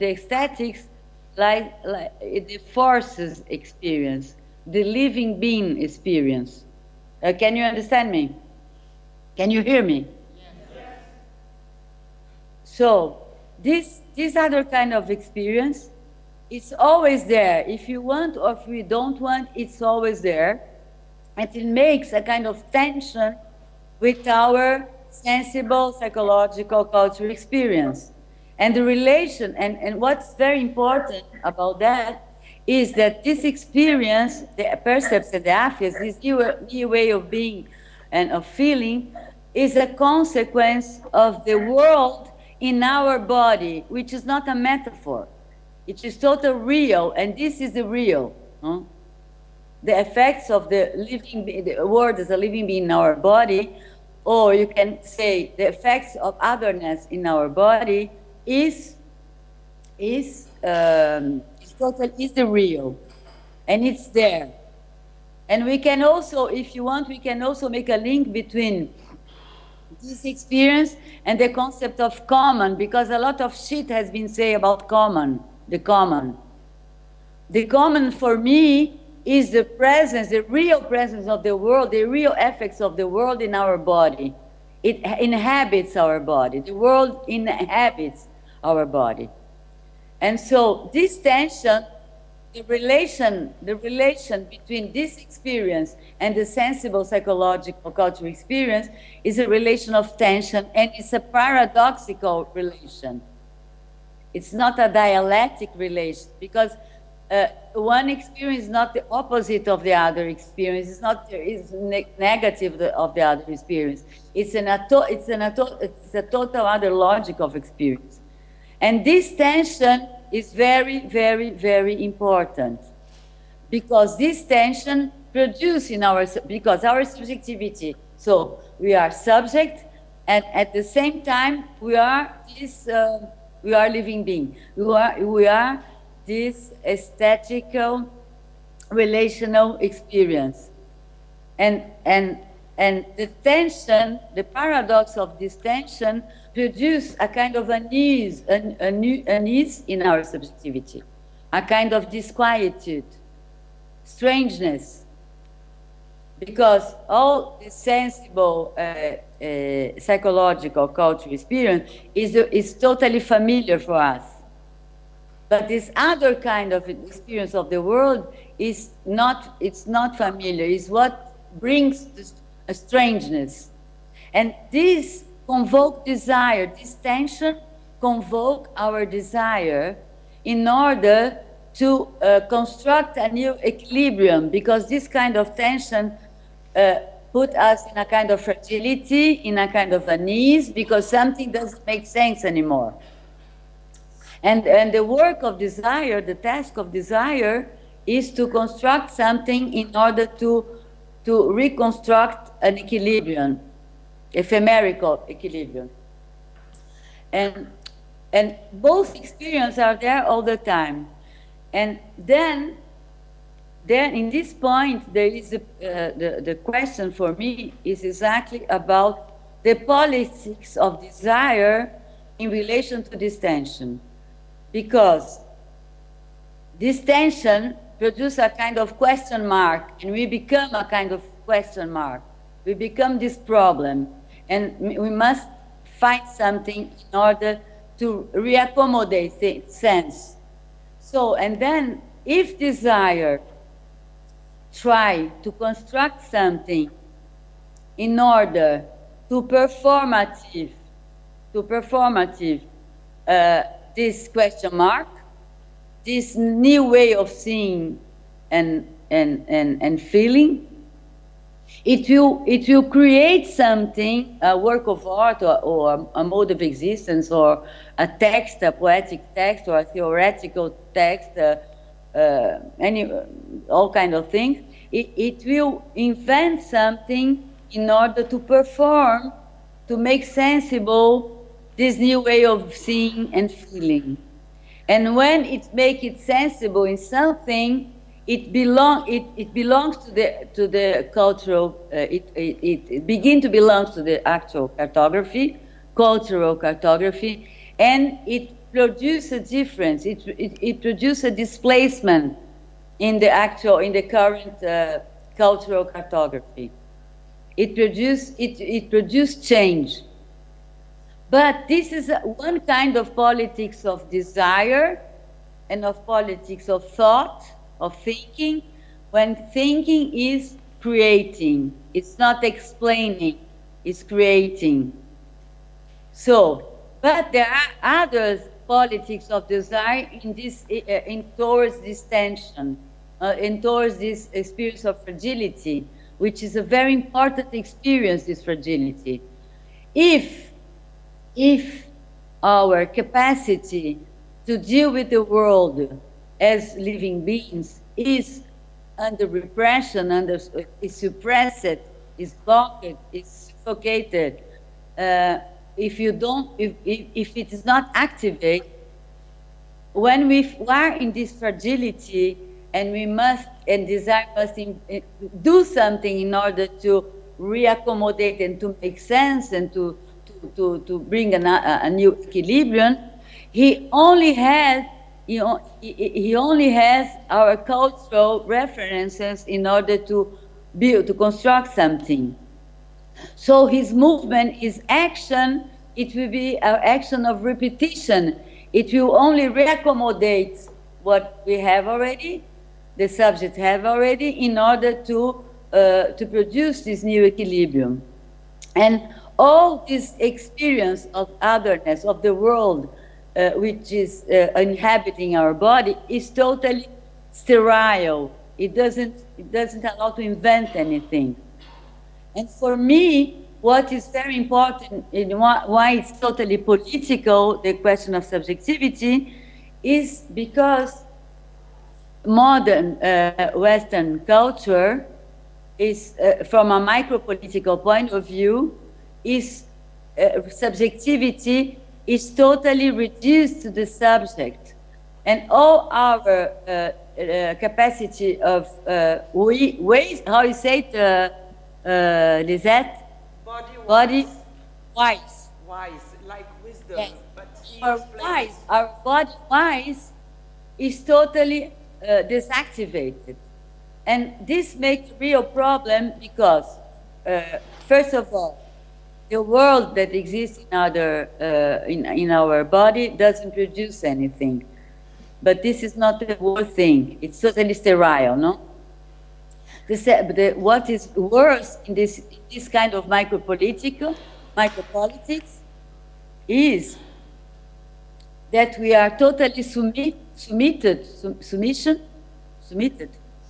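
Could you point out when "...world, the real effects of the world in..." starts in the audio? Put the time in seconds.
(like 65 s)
81 s.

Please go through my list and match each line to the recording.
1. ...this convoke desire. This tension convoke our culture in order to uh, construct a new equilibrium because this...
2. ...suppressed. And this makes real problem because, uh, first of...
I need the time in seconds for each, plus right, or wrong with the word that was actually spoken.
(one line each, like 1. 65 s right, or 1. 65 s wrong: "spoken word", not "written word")
1. 174 s wrong: "desire", not "culture"
2. 452 s wrong: "deactivated", not "suppressed".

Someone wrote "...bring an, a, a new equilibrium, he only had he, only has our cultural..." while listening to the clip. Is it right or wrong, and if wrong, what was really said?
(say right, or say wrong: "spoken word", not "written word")
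right.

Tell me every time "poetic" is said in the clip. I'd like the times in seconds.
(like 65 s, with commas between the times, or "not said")
268 s.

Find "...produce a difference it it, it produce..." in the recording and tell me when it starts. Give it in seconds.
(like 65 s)
298 s.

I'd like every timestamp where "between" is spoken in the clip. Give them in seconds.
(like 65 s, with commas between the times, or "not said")
68 s, 94 s.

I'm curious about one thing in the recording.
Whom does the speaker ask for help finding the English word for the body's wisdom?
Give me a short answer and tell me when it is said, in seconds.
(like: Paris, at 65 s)
Lisette, at 442 s.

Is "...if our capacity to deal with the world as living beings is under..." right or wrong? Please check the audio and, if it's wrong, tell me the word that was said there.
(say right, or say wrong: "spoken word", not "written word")
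right.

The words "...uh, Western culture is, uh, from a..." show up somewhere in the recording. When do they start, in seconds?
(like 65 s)
423 s.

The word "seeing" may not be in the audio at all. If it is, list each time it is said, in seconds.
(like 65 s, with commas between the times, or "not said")
257 s, 282 s.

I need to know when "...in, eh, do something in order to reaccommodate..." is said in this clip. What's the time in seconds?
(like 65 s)
364 s.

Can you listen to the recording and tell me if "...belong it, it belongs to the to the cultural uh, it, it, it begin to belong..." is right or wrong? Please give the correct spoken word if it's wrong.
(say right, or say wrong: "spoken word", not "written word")
right.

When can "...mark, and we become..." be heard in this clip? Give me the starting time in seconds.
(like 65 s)
229 s.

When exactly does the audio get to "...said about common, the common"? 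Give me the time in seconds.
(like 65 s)
74 s.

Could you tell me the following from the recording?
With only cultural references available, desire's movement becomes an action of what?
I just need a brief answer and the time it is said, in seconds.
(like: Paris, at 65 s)
repetition, at 387 s.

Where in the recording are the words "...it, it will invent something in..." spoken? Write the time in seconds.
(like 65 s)
274 s.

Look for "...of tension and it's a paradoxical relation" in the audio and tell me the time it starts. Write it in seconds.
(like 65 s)
99 s.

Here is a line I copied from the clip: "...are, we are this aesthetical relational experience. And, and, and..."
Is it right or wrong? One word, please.
right.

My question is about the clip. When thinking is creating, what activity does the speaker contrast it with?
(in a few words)
explaining.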